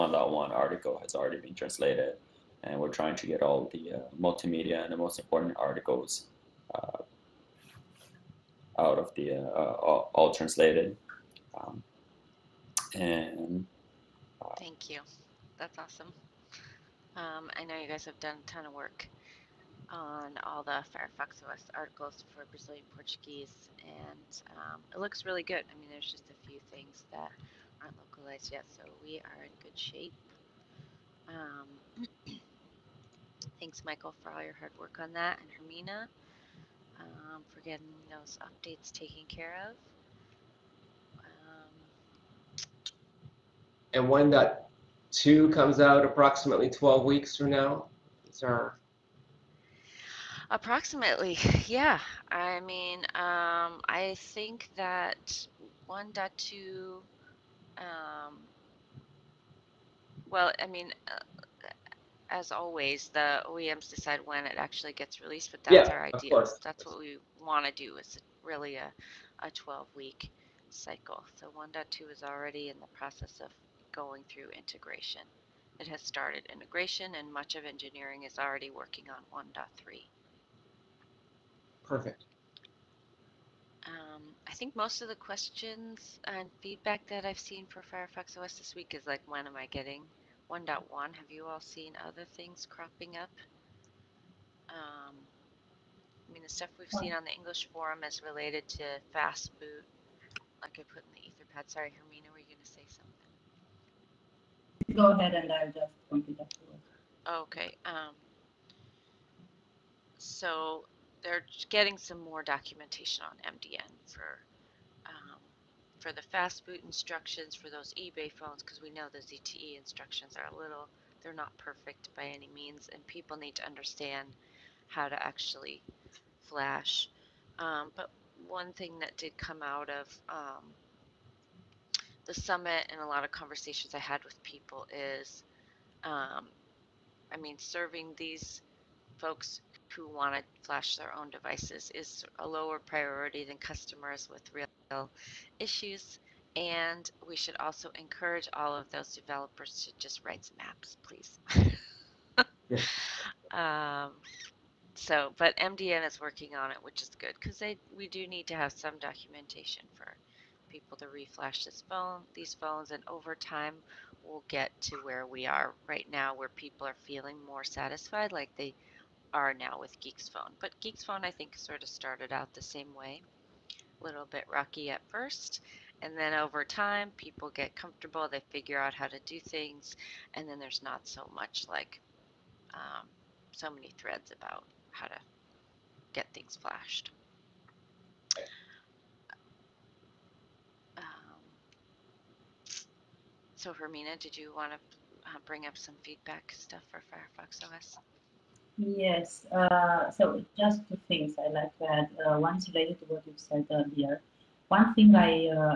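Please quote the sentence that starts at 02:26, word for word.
And we should also encourage all of those developers to just write some apps, please.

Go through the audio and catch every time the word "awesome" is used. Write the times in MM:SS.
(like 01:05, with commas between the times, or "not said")
00:15.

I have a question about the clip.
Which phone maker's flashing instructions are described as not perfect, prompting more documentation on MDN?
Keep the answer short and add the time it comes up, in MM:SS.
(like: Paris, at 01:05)
ZTE, at 01:59.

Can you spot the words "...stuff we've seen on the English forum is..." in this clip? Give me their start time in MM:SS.
01:36.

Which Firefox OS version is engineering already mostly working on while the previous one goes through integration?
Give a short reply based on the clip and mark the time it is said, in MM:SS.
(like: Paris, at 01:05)
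1.3, at 01:19.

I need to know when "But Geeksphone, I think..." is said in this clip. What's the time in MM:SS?
02:50.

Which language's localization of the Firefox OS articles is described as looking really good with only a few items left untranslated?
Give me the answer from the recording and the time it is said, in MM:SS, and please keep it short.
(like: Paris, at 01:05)
Brazilian Portuguese, at 00:22.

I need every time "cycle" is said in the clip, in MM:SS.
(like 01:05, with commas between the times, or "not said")
01:10.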